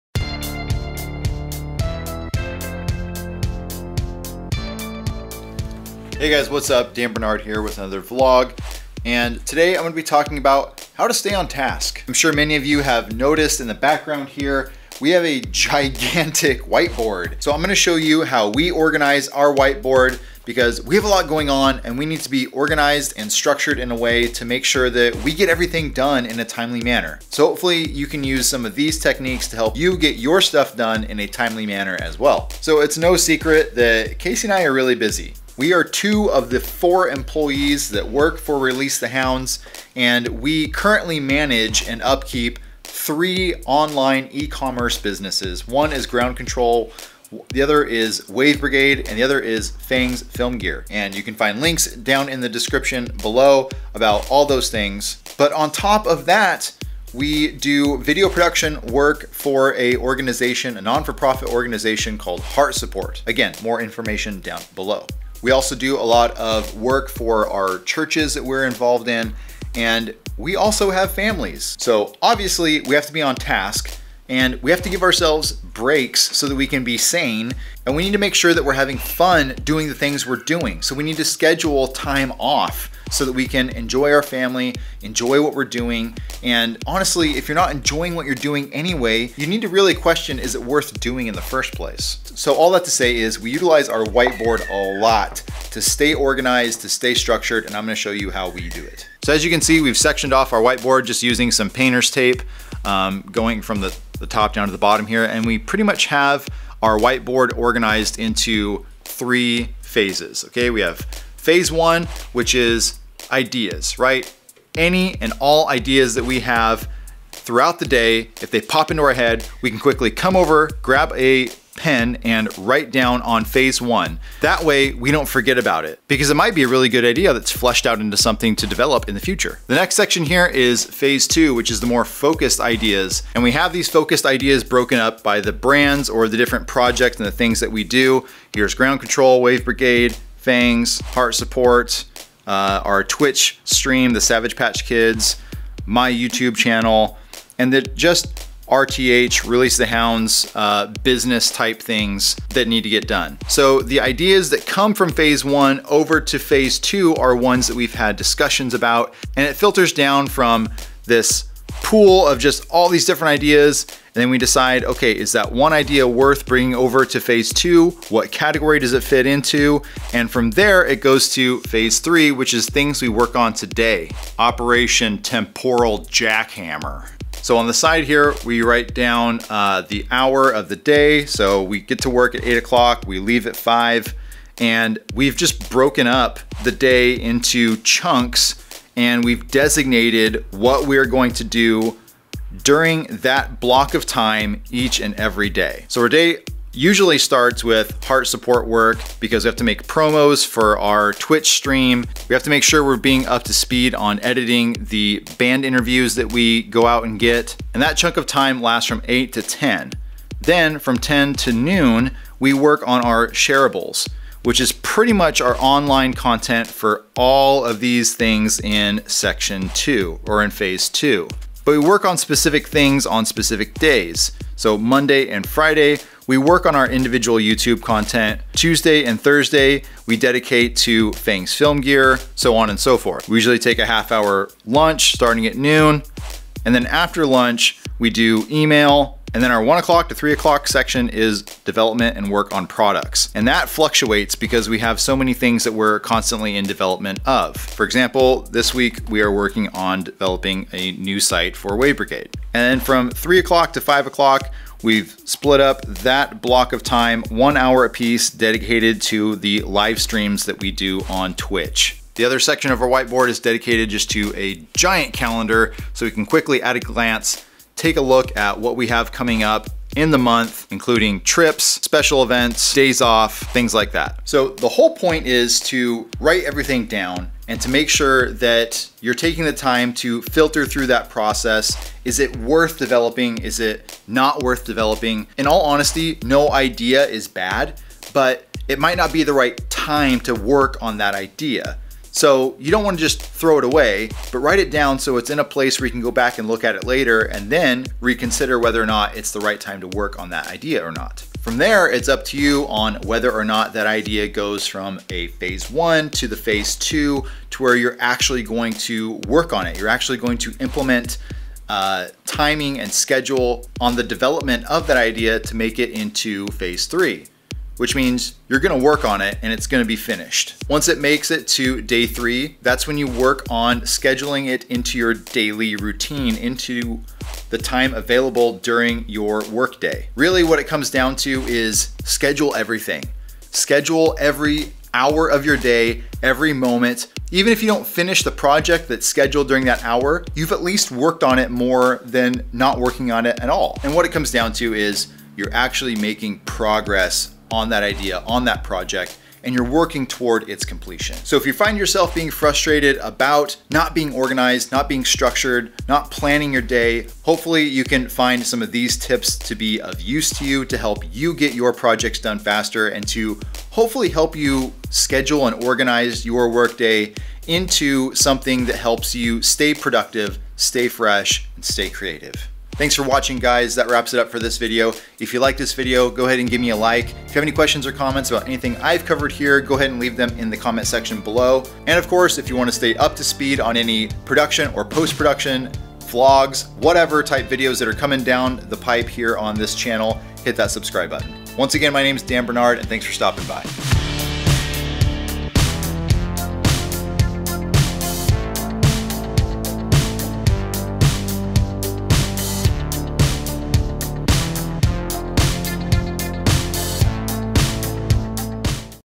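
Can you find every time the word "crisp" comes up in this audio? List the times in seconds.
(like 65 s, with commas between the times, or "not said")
not said.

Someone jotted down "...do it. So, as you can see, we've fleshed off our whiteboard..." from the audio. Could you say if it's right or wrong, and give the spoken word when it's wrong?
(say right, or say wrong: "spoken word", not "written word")
wrong: "sectioned", not "fleshed".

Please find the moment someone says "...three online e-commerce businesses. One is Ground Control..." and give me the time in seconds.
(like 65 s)
42 s.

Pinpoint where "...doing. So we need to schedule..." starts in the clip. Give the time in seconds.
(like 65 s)
80 s.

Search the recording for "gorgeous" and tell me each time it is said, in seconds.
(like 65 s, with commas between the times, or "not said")
not said.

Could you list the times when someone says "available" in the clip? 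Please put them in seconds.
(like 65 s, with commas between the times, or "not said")
327 s.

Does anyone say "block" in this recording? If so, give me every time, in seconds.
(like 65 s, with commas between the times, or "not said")
193 s, 256 s.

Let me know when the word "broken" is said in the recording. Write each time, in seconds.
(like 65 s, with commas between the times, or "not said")
134 s, 185 s.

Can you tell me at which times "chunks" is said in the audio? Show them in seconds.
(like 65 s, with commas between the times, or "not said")
187 s, 207 s.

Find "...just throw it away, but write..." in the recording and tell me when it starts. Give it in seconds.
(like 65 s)
293 s.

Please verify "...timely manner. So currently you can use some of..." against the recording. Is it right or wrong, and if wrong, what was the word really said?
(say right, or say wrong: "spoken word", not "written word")
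wrong: "hopefully", not "currently".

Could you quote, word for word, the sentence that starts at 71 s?
So obviously we have to be on task and we have to give ourselves breaks so that we can be sane.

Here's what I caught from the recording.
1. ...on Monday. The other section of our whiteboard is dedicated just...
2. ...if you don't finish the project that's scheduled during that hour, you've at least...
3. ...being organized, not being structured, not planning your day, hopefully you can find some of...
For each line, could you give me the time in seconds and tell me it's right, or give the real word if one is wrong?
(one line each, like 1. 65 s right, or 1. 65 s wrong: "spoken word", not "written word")
1. 261 s wrong: "Twitch", not "Monday"
2. 337 s right
3. 353 s right.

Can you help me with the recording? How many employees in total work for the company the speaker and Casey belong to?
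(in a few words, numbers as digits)
4.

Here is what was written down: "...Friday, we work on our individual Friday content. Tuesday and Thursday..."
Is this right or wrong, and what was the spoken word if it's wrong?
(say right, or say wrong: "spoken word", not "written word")
wrong: "YouTube", not "Friday".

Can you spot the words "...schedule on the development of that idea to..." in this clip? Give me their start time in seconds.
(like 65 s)
312 s.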